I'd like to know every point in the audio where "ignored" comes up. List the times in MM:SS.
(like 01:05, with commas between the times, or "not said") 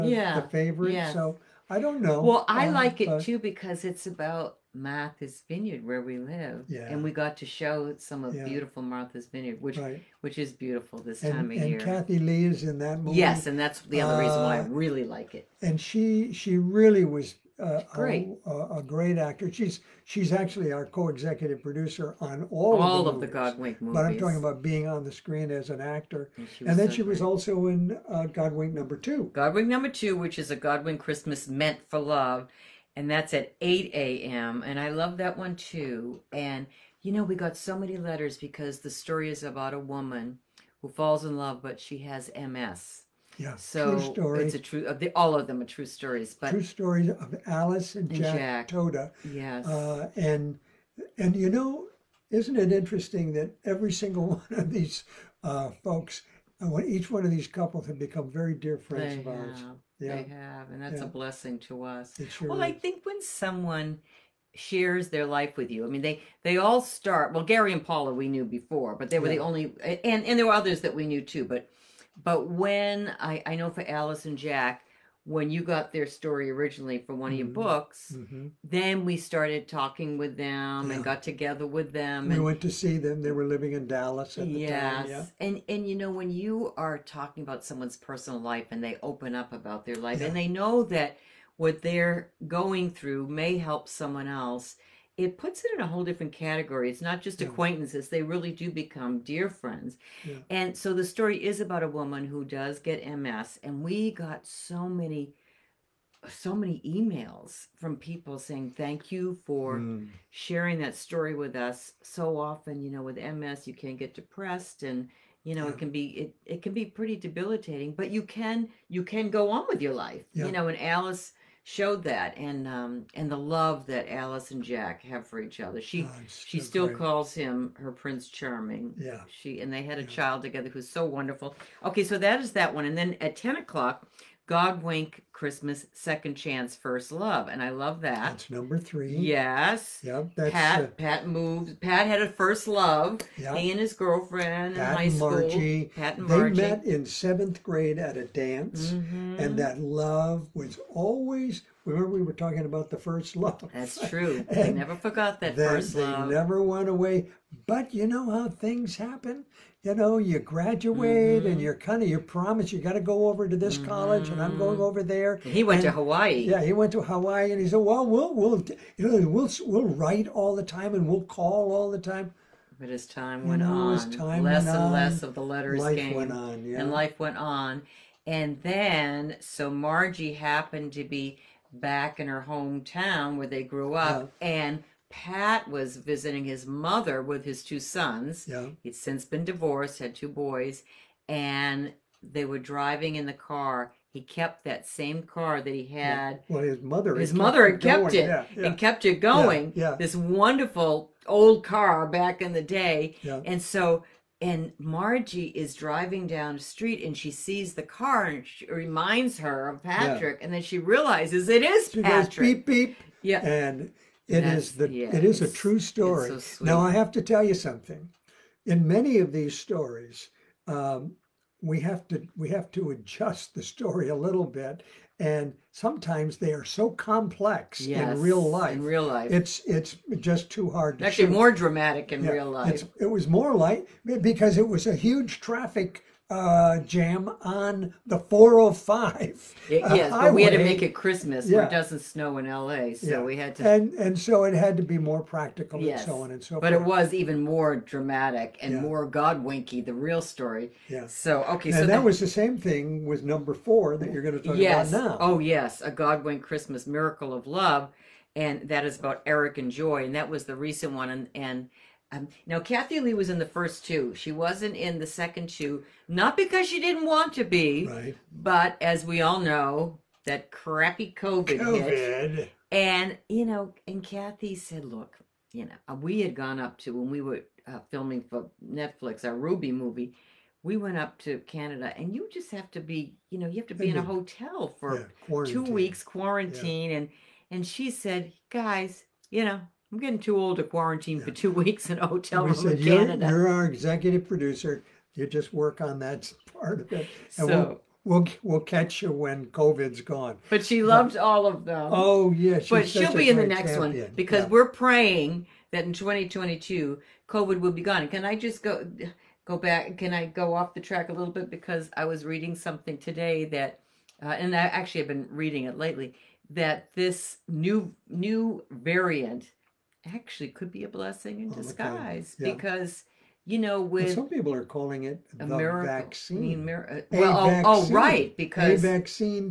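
not said.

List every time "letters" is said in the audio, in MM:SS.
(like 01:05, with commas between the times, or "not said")
00:37, 02:55.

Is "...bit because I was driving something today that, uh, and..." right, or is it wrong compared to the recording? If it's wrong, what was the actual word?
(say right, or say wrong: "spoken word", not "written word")
wrong: "reading", not "driving".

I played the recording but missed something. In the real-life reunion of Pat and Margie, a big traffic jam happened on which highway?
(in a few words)
the 405.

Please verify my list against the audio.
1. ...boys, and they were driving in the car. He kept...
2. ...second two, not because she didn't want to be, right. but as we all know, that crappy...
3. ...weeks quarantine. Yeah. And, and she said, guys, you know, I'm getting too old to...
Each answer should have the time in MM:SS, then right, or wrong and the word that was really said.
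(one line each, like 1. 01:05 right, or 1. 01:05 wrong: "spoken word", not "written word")
1. 03:10 right
2. 04:25 right
3. 04:45 right.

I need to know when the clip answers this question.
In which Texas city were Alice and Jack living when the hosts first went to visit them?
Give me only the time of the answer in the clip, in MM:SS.
01:23.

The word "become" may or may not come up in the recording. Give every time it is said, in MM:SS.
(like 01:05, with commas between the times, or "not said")
00:57, 01:38.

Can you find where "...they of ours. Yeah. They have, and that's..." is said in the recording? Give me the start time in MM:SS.
00:59.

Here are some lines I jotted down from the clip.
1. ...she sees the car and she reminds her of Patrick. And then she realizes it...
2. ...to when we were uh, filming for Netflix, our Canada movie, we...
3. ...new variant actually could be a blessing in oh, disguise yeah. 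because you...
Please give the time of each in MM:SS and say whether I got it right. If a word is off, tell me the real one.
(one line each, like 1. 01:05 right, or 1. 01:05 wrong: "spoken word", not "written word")
1. 03:27 right
2. 04:36 wrong: "Ruby", not "Canada"
3. 05:18 right.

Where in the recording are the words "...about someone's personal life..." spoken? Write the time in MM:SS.
01:27.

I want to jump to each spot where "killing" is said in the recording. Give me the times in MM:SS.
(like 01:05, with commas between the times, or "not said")
not said.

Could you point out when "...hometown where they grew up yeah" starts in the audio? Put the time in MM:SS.
03:02.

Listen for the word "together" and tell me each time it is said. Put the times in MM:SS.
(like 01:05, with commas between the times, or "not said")
01:21, 02:10.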